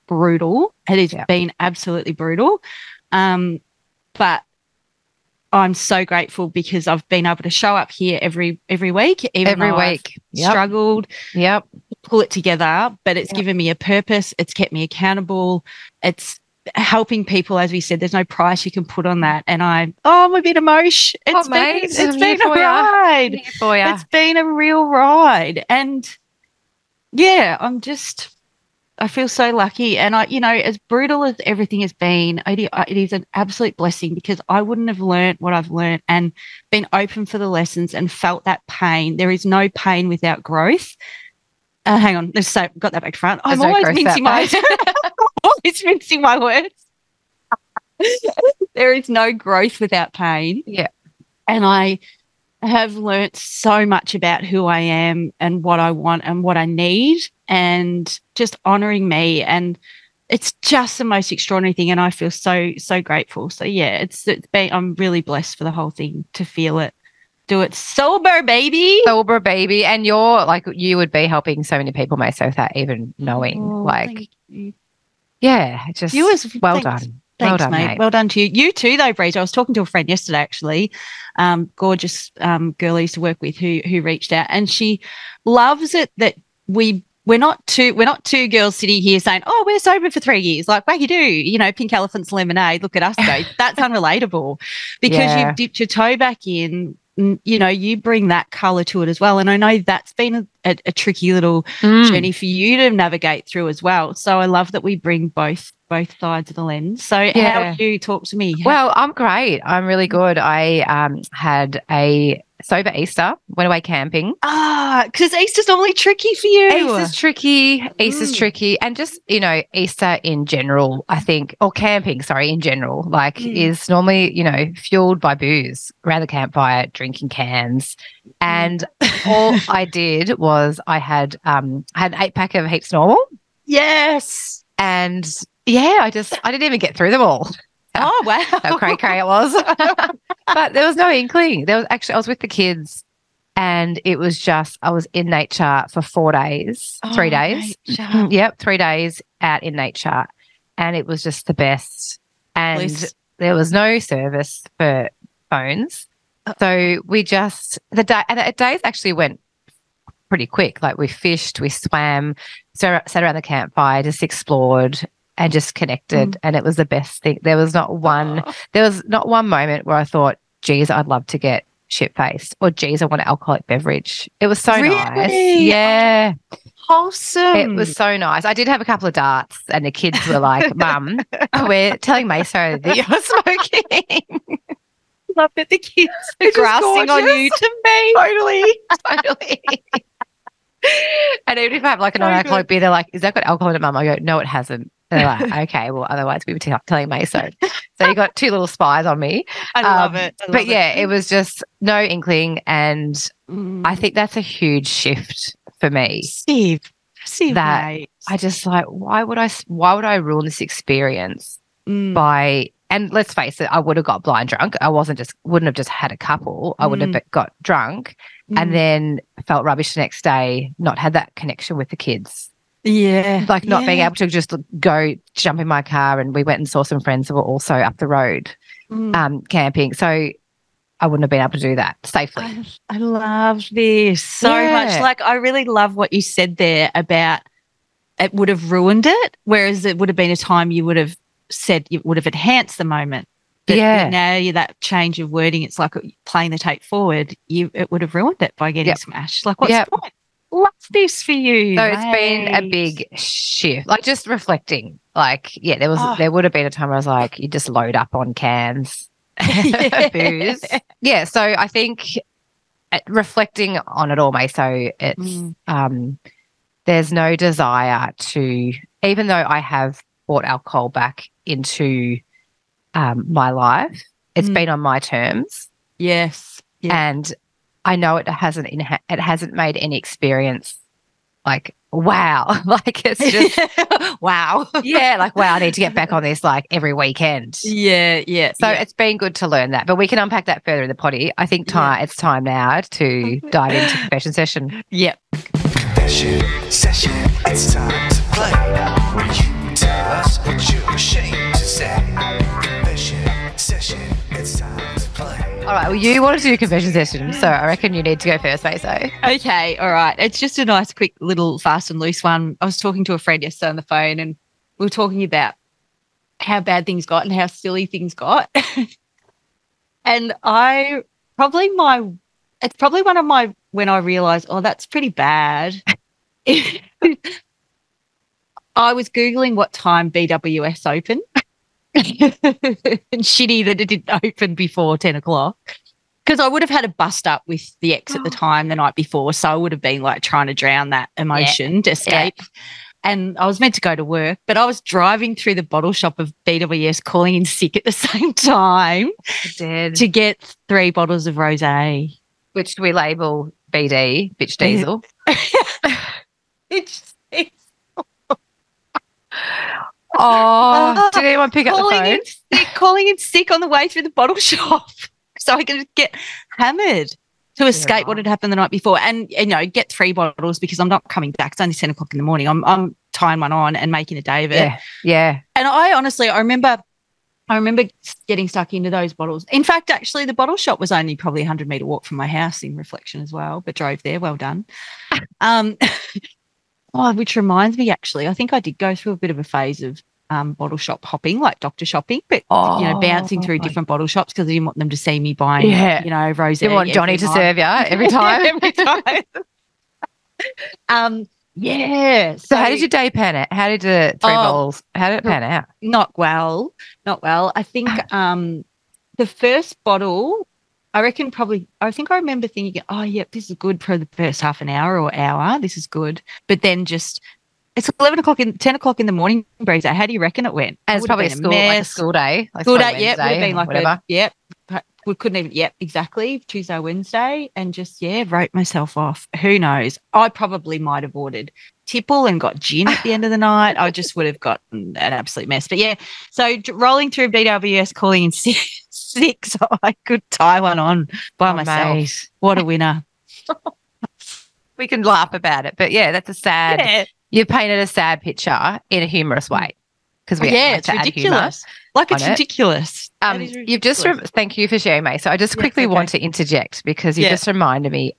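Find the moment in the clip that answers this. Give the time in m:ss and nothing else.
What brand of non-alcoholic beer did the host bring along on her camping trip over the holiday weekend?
2:12.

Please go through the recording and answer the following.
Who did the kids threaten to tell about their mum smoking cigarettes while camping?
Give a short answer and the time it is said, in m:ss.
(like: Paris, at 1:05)
Maso, at 3:02.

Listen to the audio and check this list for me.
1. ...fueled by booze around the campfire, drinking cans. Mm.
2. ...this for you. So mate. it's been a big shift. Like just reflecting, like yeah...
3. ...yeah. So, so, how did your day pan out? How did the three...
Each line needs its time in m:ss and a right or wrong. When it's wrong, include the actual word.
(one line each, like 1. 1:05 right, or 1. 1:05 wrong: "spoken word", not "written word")
1. 2:04 right
2. 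4:10 right
3. 6:41 right.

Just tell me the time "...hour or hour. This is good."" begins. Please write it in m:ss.
6:54.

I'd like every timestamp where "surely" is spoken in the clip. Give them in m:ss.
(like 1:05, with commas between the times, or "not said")
not said.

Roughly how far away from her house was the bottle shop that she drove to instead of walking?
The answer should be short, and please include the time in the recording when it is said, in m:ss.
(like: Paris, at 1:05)
100 meters, at 6:21.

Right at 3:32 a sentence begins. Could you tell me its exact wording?
by, and let's face it, I would have got blind drunk.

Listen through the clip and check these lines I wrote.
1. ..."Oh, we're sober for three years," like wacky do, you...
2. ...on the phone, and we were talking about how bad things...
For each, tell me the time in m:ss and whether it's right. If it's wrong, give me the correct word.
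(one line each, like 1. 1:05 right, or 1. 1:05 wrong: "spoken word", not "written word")
1. 1:29 right
2. 5:13 right.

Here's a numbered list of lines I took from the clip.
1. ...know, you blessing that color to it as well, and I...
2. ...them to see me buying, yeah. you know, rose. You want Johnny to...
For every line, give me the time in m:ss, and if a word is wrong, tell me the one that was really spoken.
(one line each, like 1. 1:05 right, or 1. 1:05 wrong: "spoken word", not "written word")
1. 1:37 wrong: "bring", not "blessing"
2. 6:34 right.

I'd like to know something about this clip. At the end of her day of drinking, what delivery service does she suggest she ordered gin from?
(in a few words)
Tipple.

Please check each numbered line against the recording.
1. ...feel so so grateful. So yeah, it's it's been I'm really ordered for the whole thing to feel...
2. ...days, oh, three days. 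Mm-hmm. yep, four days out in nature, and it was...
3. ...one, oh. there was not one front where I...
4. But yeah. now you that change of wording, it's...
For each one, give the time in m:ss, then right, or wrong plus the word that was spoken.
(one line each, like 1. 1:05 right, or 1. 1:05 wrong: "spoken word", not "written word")
1. 1:02 wrong: "blessed", not "ordered"
2. 2:26 wrong: "three", not "four"
3. 2:48 wrong: "moment", not "front"
4. 4:03 right.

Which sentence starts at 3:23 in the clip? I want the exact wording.
I think that's a huge shift for me.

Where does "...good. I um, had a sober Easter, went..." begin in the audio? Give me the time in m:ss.
1:50.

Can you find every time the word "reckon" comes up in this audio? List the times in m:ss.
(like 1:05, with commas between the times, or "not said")
5:07, 6:51, 7:00.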